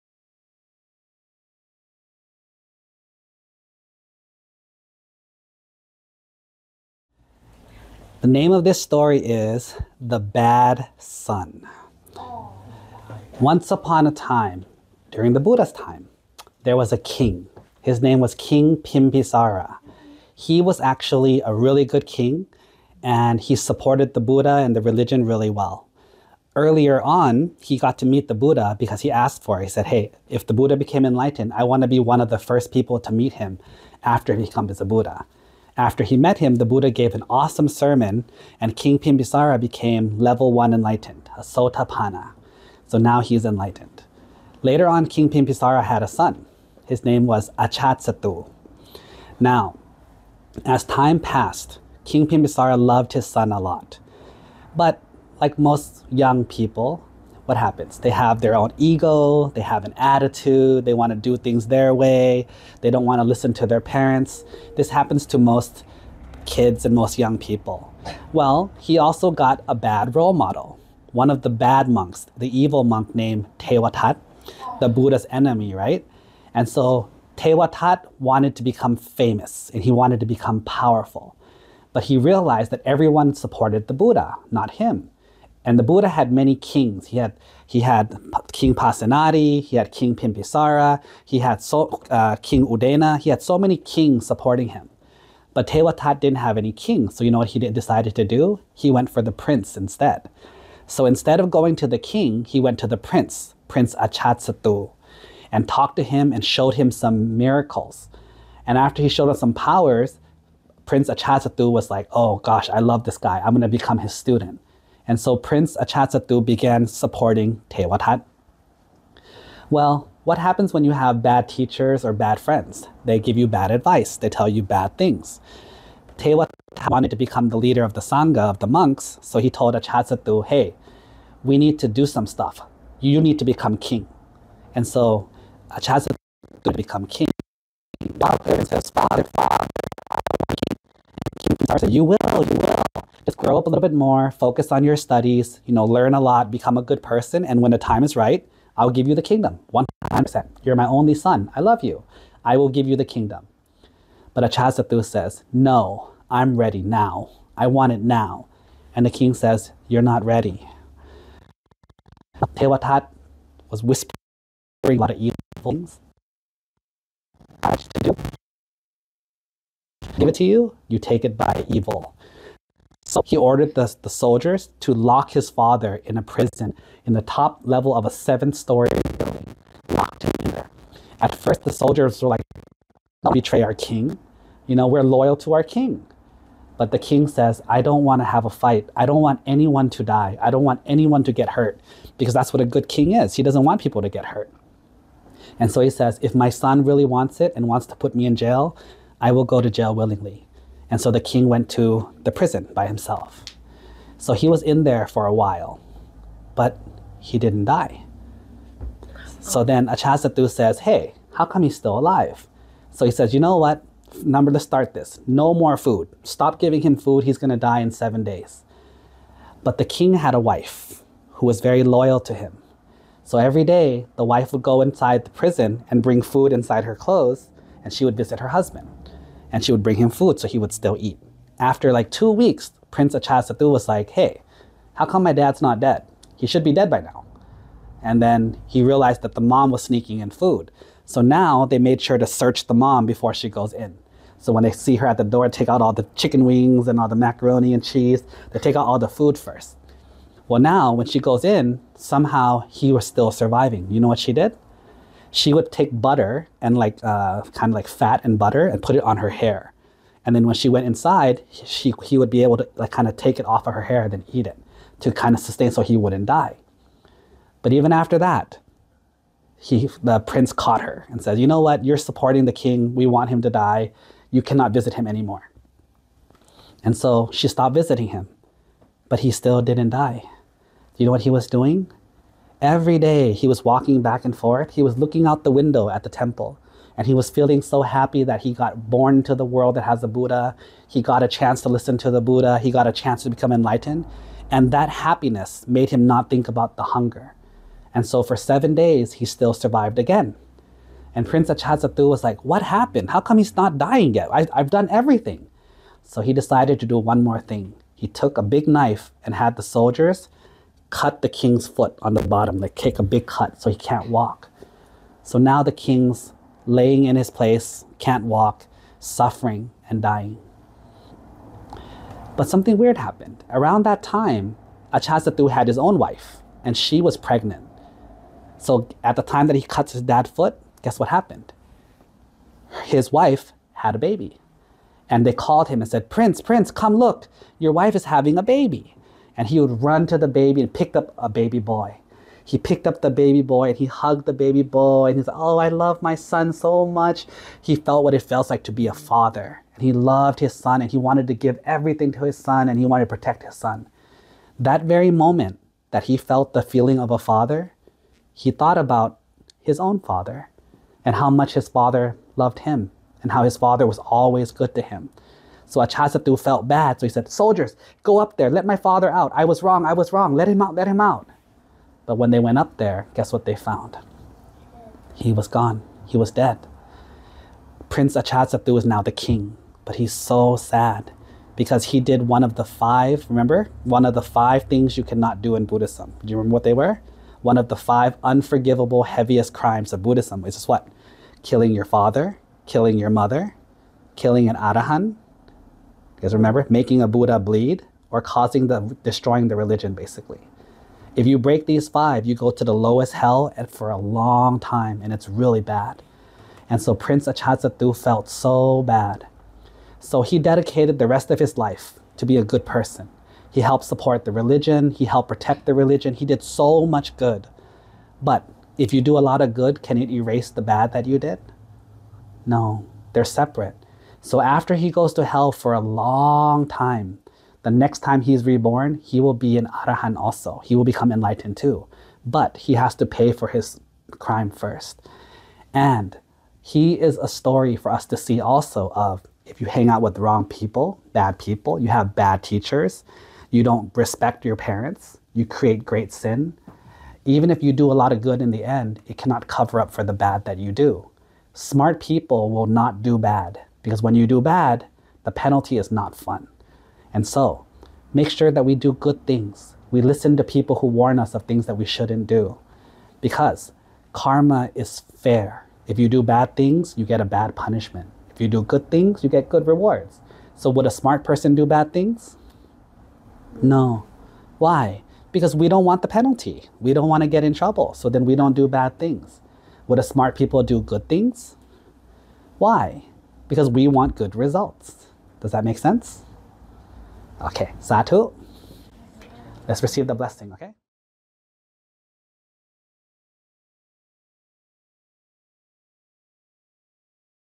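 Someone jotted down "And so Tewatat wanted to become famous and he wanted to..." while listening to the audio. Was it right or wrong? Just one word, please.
right.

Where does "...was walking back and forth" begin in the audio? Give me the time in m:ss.
4:43.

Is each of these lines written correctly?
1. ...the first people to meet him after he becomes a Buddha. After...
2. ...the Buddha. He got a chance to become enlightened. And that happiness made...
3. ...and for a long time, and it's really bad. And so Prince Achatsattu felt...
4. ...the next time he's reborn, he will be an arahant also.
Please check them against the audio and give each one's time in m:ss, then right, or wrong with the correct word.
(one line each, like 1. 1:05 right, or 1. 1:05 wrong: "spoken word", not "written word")
1. 0:32 right
2. 4:52 right
3. 6:43 right
4. 7:07 right.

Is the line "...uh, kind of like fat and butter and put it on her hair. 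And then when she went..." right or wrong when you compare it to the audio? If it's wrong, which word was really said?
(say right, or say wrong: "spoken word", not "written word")
right.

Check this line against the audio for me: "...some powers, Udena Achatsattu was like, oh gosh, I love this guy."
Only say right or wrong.
wrong.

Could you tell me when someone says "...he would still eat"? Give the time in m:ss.
3:50.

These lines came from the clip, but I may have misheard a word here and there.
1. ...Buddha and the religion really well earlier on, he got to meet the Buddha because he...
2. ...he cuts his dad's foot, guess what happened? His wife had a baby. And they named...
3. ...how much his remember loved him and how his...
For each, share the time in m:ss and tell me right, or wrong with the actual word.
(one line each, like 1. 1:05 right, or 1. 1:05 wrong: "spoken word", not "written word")
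1. 0:24 right
2. 5:29 wrong: "called", not "named"
3. 6:01 wrong: "father", not "remember".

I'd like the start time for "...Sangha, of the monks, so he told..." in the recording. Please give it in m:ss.
2:08.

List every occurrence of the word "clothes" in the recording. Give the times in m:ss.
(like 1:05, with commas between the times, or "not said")
3:46.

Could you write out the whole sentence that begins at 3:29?
So then Achasattu says, Hey, how come he's still alive?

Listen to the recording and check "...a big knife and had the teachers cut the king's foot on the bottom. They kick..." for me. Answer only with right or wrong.
wrong.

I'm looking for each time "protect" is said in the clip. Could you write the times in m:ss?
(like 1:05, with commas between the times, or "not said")
5:53, 6:55.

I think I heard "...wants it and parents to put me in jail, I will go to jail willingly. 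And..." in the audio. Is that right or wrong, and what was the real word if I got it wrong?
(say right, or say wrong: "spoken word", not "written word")
wrong: "wants", not "parents".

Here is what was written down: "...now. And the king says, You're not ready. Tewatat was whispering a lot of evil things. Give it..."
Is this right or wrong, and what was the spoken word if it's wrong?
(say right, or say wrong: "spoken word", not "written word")
right.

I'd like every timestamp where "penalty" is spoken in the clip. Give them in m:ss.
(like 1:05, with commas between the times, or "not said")
7:35, 7:56.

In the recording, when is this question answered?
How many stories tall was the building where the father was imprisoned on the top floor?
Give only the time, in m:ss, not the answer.
2:58.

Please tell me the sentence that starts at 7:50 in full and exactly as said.
So, would a smart person do bad things?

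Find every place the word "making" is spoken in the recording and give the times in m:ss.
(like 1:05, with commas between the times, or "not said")
6:36.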